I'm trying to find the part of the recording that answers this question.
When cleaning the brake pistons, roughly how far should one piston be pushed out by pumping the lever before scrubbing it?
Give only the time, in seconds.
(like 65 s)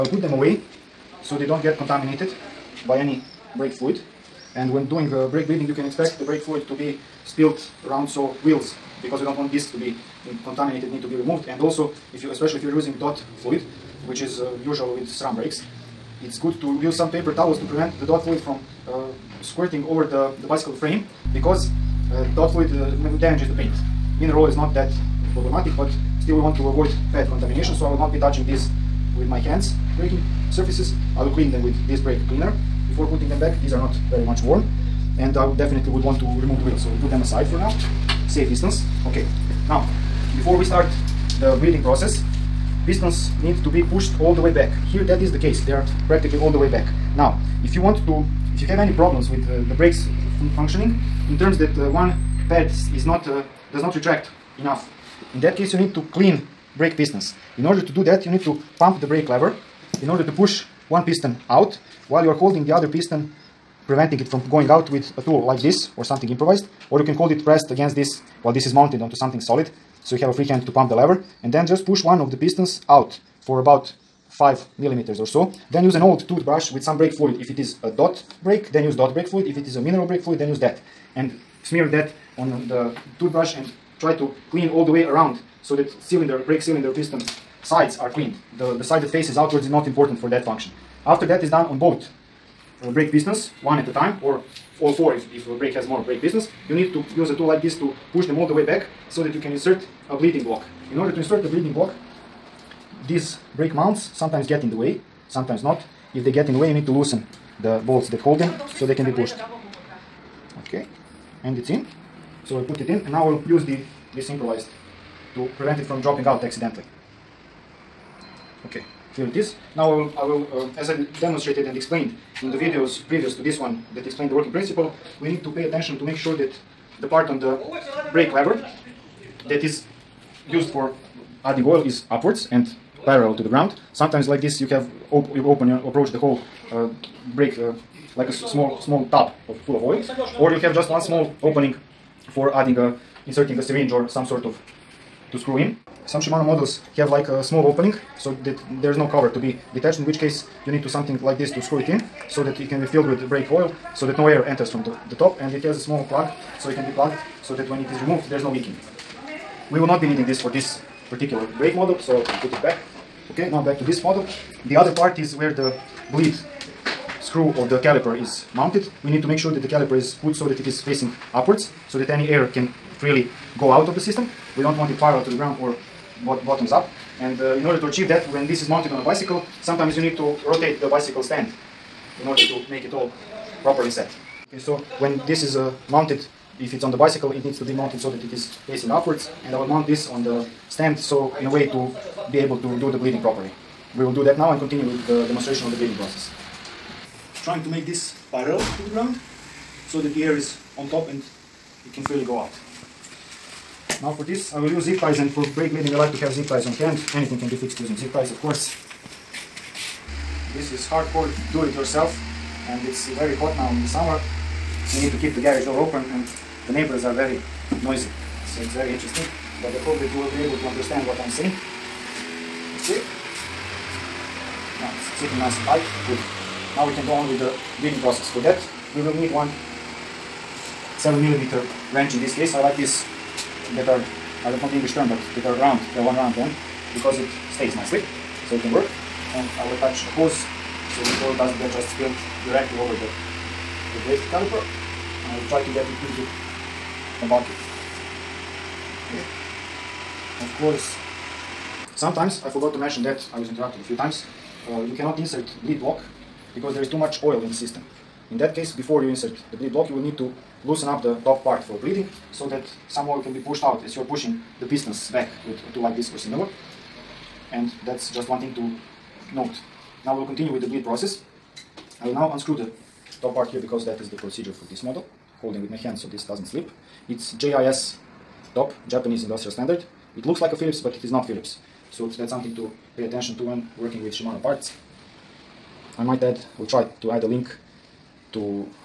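74 s.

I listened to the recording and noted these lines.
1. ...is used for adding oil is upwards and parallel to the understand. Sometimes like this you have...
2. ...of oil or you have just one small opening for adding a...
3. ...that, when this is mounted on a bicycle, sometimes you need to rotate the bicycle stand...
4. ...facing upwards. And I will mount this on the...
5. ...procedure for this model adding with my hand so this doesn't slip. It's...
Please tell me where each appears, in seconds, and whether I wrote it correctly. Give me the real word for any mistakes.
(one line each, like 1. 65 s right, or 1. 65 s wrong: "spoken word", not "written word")
1. 129 s wrong: "ground", not "understand"
2. 139 s right
3. 178 s right
4. 188 s right
5. 274 s wrong: "holding", not "adding".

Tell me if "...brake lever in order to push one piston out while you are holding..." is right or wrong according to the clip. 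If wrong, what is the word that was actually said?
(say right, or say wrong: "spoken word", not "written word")
right.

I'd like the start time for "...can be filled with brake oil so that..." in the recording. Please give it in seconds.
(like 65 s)
152 s.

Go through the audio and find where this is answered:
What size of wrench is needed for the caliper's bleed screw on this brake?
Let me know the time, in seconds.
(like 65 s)
230 s.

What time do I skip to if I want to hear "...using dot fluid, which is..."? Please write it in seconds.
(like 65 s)
12 s.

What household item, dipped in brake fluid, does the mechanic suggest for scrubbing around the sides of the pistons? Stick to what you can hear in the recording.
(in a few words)
Old toothbrush.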